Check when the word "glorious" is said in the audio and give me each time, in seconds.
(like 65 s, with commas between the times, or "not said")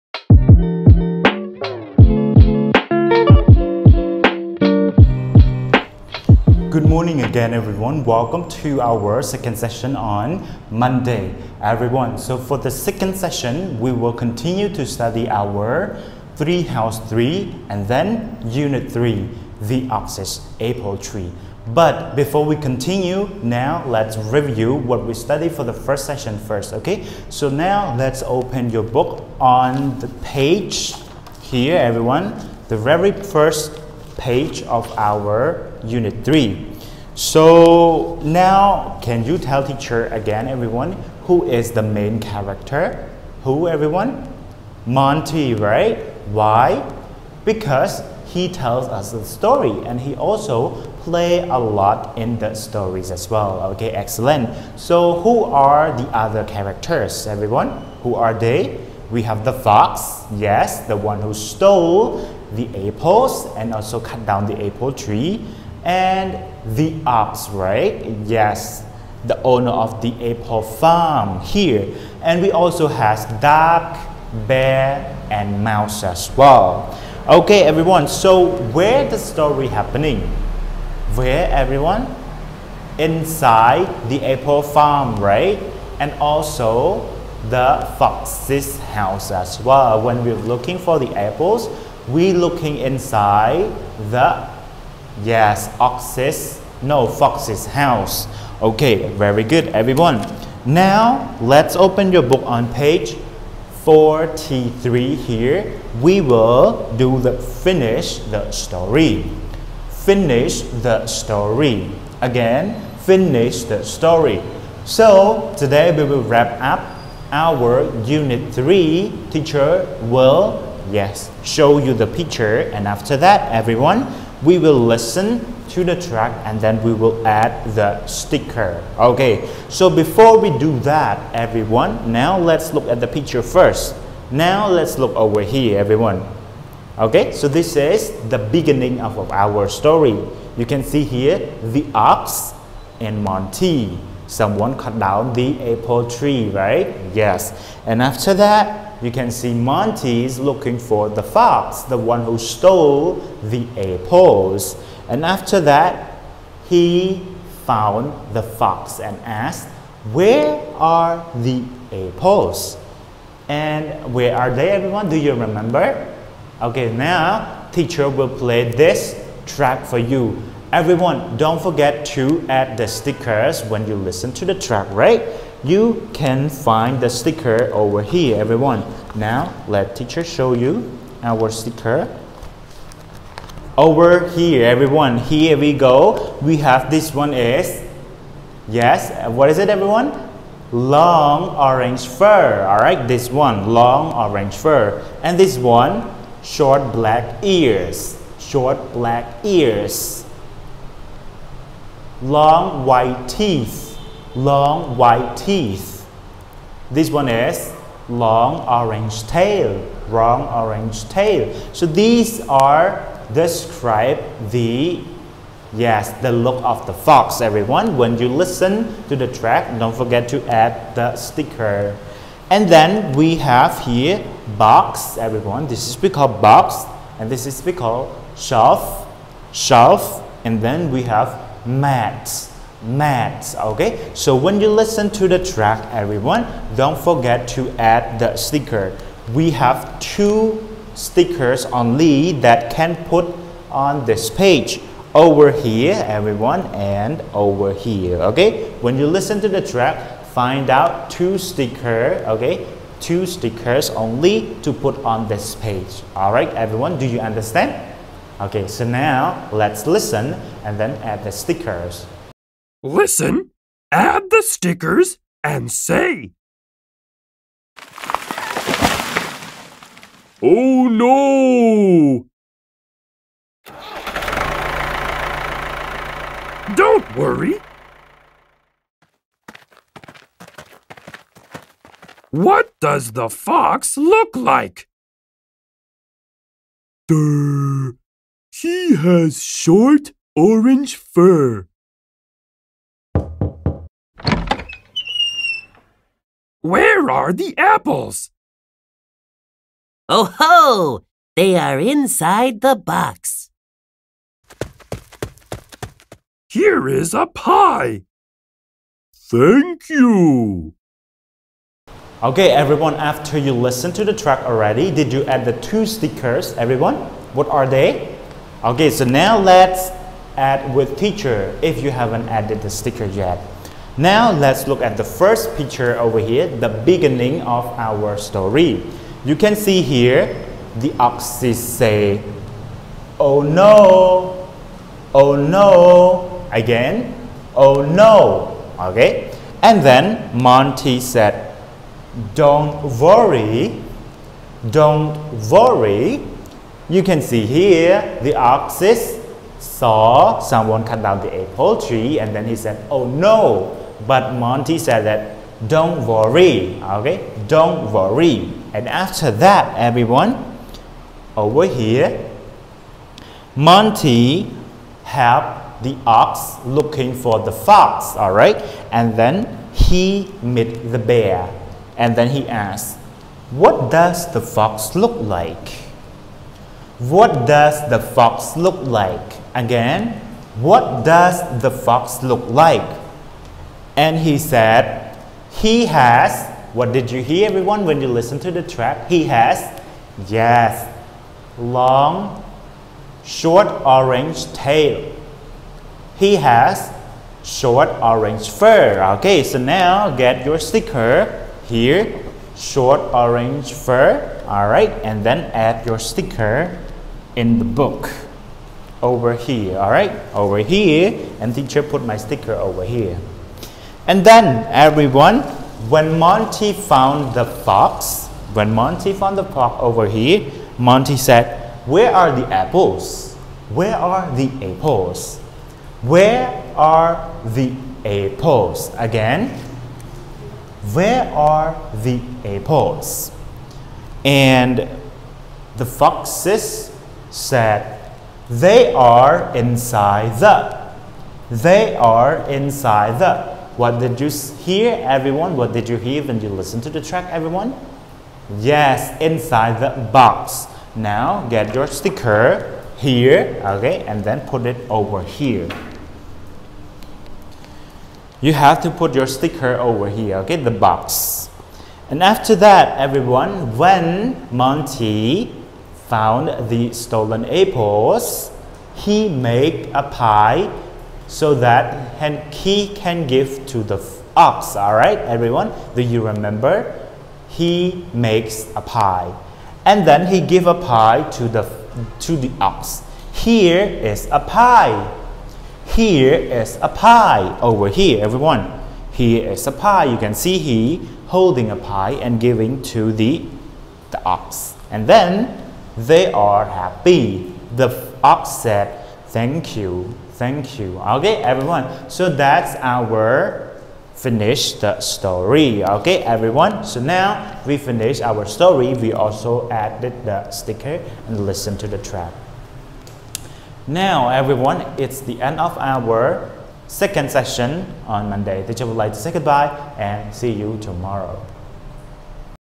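not said.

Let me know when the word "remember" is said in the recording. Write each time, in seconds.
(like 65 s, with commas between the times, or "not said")
165 s, 476 s.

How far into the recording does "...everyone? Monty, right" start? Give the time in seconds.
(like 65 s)
43 s.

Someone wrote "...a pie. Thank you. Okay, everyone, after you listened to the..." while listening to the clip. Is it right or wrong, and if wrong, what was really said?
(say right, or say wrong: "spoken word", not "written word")
right.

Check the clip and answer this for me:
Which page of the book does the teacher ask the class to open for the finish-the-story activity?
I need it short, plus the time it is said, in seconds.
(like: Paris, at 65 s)
43, at 102 s.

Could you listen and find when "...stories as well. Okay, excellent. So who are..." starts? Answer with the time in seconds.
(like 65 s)
52 s.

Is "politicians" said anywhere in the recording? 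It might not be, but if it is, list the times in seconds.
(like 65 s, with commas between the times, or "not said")
not said.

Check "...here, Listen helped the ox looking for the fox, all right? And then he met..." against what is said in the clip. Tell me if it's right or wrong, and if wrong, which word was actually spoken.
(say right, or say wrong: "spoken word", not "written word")
wrong: "Monty", not "Listen".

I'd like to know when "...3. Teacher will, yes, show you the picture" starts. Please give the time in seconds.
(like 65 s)
118 s.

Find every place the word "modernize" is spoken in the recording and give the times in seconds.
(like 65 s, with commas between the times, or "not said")
not said.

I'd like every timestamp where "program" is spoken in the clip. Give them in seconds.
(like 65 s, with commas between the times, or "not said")
not said.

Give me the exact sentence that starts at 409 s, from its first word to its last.
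All right, over here, and teacher put my sticker over here.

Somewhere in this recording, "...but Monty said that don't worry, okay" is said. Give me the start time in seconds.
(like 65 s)
354 s.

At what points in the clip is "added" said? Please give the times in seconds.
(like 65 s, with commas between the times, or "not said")
322 s, 509 s.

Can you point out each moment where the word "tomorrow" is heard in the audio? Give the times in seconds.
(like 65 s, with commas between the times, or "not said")
520 s.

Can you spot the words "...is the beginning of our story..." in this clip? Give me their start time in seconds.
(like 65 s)
137 s.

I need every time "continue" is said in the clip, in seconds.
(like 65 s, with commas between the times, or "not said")
14 s, 22 s.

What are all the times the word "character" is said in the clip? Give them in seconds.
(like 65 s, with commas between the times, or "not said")
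42 s, 56 s.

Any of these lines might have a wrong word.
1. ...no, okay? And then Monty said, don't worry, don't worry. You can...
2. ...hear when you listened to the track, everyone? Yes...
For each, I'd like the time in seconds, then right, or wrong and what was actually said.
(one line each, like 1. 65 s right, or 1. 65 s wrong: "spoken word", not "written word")
1. 337 s right
2. 445 s right.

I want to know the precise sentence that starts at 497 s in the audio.
The ox said, "Thank you." Thank you.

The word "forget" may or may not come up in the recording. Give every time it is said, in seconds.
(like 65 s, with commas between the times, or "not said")
171 s, 219 s, 236 s.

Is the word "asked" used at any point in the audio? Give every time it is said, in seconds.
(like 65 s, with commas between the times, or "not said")
159 s, 372 s.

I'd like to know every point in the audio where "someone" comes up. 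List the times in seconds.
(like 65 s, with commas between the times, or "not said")
144 s, 350 s.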